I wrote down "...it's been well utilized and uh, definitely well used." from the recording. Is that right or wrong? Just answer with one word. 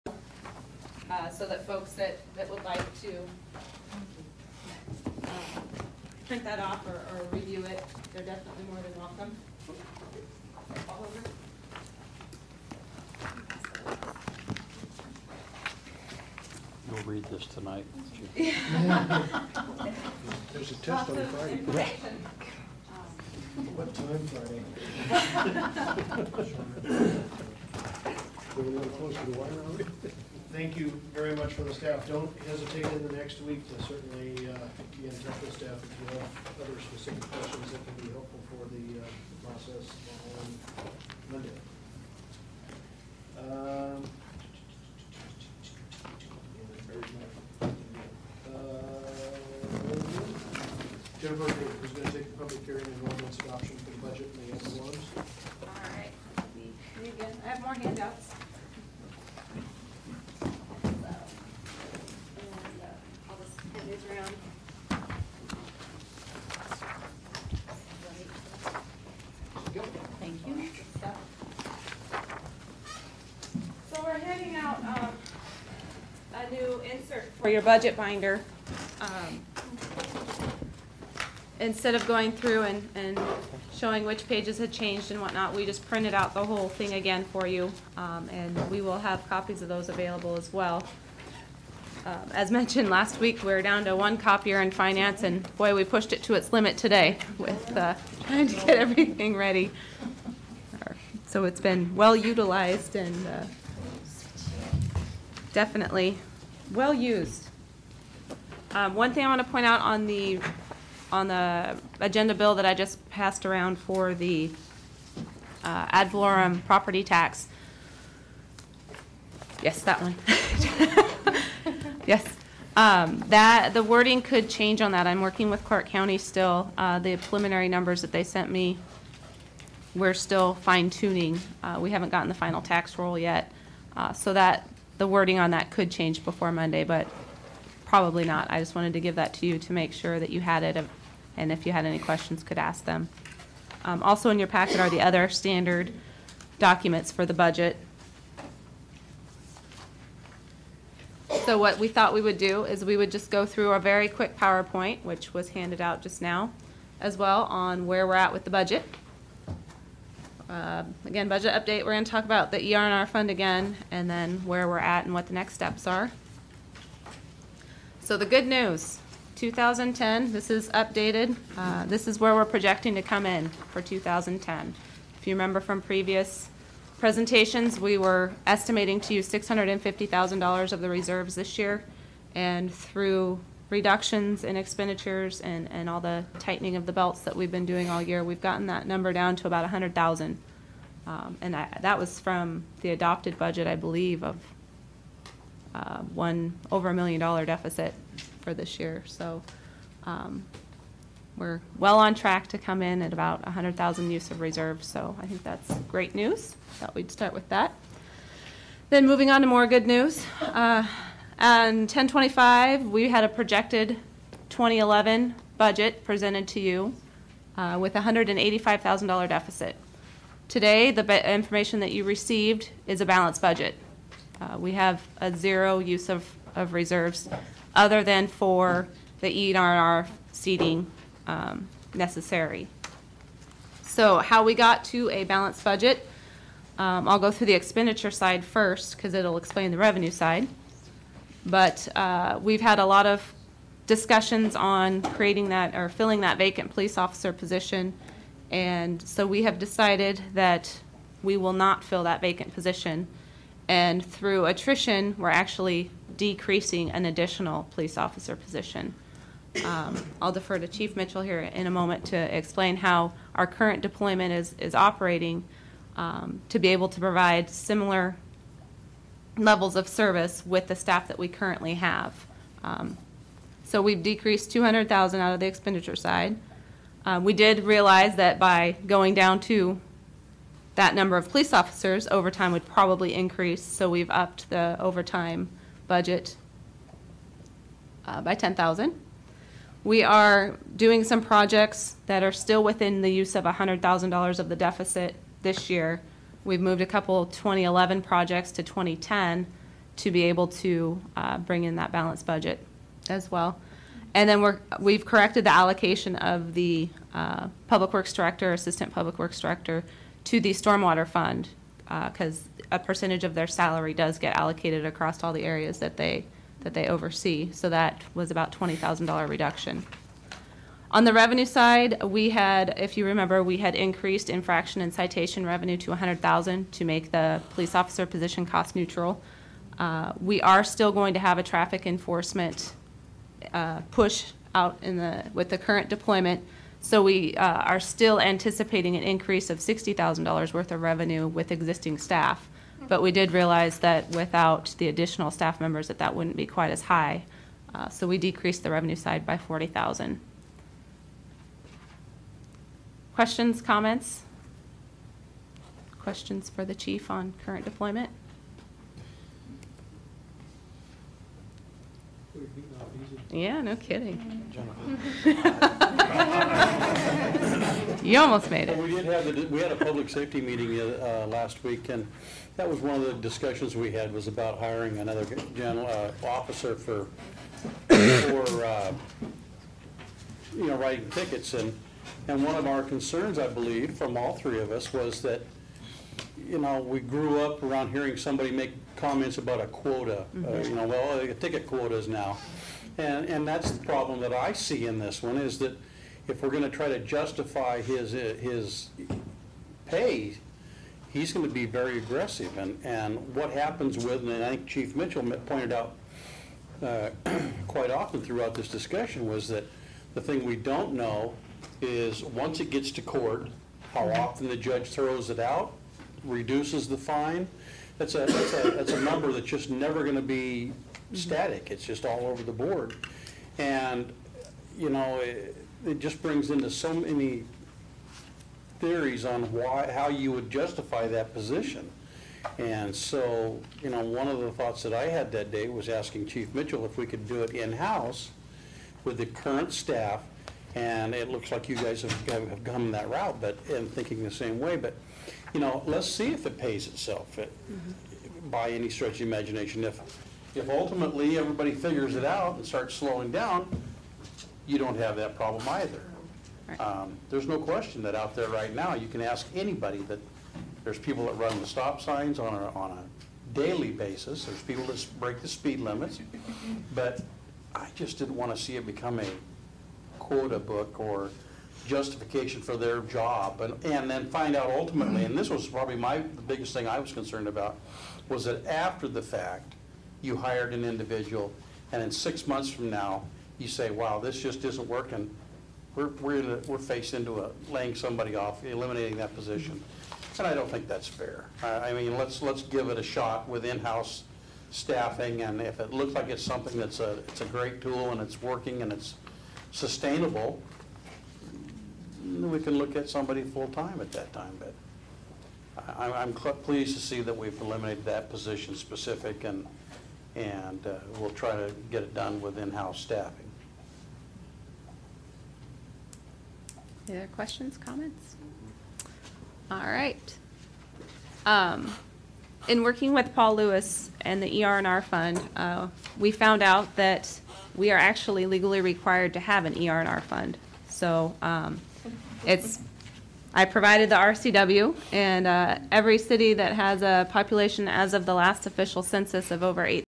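right.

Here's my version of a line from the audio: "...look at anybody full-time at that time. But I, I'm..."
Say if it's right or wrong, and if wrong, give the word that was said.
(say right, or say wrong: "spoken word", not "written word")
wrong: "somebody", not "anybody".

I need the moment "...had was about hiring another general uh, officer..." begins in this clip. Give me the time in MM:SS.
06:13.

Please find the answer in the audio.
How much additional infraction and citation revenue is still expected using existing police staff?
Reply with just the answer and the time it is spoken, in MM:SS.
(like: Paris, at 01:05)
$60,000, at 05:39.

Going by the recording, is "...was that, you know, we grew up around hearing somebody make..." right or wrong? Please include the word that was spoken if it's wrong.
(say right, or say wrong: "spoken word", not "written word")
right.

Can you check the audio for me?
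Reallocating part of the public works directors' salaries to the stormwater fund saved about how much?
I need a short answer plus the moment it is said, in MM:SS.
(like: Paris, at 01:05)
$20,000, at 05:18.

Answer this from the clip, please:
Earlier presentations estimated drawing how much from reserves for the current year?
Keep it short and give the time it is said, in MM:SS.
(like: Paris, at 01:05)
$650,000, at 02:59.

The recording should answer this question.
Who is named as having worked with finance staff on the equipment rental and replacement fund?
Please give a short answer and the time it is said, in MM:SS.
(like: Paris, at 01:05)
Paul Lewis, at 08:43.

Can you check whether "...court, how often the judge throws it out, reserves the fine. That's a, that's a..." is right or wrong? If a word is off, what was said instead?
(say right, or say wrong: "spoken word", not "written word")
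wrong: "reduces", not "reserves".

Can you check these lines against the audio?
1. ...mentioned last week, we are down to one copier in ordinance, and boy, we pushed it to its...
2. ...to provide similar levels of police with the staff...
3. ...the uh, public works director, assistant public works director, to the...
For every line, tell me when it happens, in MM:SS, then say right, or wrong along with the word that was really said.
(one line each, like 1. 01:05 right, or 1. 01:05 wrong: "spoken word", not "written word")
1. 01:32 wrong: "finance", not "ordinance"
2. 04:26 wrong: "service", not "police"
3. 05:06 right.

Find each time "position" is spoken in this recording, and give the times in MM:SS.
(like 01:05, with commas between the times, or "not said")
04:07, 04:12, 04:18, 05:28, 07:11, 08:09, 08:28.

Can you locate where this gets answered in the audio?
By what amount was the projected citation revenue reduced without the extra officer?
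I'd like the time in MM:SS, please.
05:49.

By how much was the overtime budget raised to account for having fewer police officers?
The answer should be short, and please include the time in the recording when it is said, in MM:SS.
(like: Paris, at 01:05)
10,000, at 04:48.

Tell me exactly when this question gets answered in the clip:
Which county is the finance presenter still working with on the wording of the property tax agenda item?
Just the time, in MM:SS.
02:05.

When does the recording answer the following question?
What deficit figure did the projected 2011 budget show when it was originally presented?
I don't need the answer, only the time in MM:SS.
03:37.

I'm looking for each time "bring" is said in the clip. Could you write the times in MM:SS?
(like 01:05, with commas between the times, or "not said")
05:01, 07:06.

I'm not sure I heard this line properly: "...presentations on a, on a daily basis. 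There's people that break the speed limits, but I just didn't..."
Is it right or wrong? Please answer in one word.
wrong.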